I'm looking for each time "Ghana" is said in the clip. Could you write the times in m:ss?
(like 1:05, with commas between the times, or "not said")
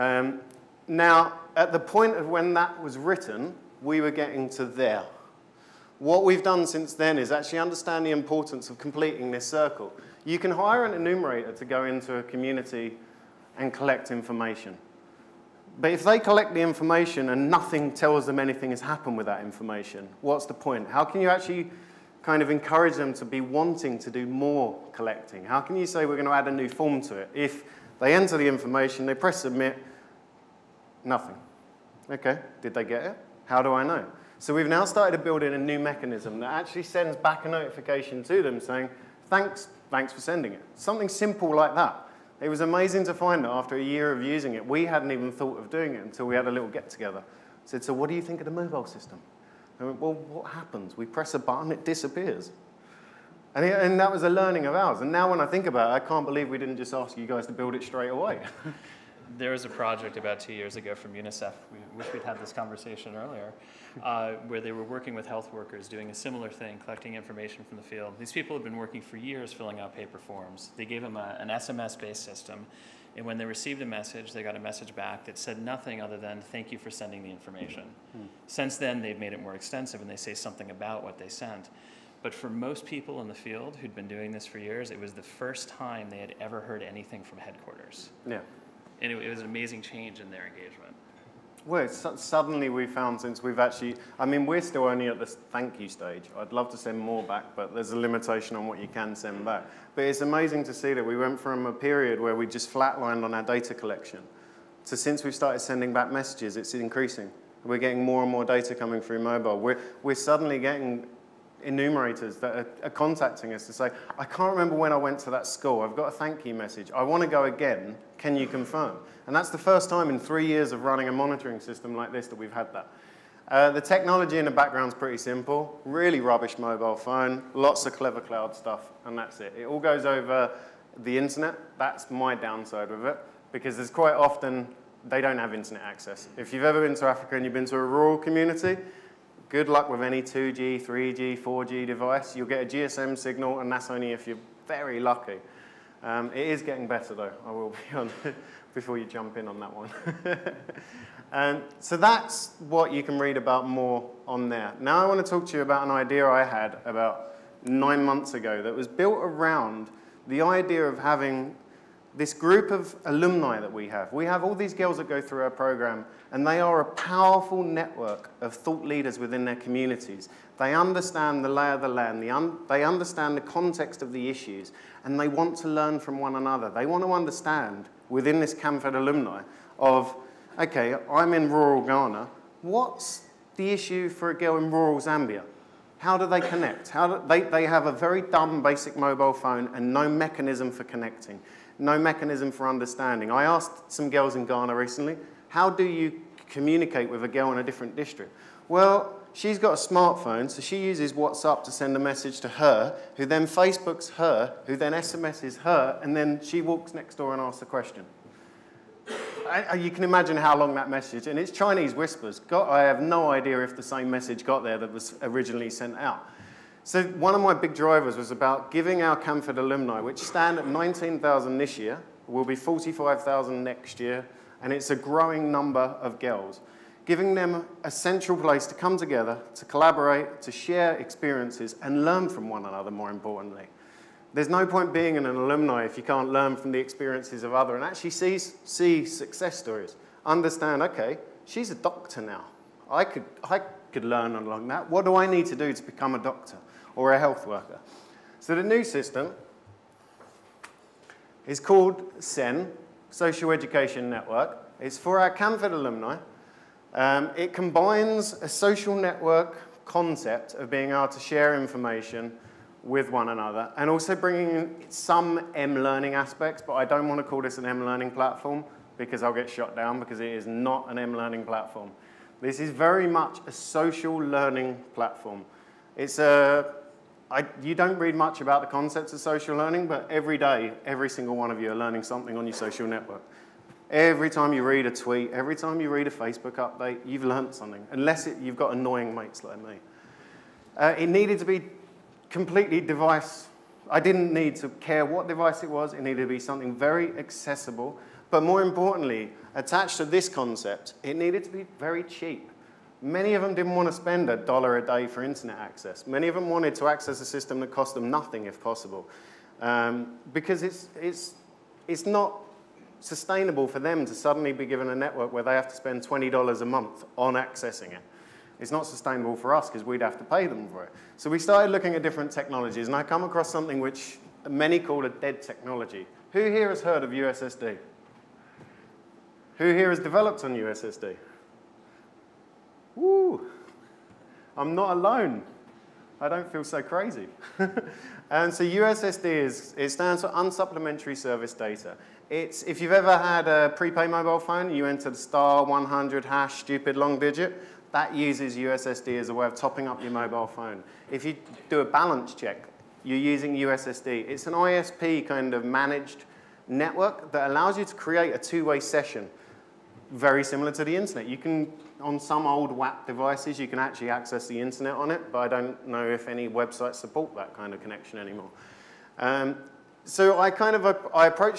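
3:01, 3:14.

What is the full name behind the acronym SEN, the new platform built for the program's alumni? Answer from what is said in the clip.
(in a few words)
Social Education Network.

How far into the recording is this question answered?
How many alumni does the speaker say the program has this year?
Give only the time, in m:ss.
3:40.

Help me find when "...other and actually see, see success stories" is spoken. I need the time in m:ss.
3:57.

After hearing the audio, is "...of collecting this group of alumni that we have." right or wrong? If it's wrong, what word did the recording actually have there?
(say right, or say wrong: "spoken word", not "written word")
wrong: "having", not "collecting".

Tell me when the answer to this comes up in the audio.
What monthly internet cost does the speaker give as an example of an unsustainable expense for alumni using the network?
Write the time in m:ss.
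5:16.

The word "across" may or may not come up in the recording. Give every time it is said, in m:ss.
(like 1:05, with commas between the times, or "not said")
5:23.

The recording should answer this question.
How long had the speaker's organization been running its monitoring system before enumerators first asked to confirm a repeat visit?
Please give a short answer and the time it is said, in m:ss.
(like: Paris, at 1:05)
3 years, at 2:00.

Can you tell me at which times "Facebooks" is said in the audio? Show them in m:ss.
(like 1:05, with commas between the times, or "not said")
3:23, 4:46.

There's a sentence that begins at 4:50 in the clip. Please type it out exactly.
Uh, it needed to be completely device.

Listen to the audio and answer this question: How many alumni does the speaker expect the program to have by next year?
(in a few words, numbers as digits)
45,000.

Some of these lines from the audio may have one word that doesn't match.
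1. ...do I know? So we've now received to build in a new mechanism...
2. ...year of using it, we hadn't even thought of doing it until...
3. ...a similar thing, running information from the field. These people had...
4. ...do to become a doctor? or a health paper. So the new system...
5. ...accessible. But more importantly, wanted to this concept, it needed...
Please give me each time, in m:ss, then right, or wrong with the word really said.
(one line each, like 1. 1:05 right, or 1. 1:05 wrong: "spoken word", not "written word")
1. 0:33 wrong: "started", not "received"
2. 0:43 right
3. 1:06 wrong: "collecting", not "running"
4. 4:05 wrong: "worker", not "paper"
5. 4:57 wrong: "attached", not "wanted".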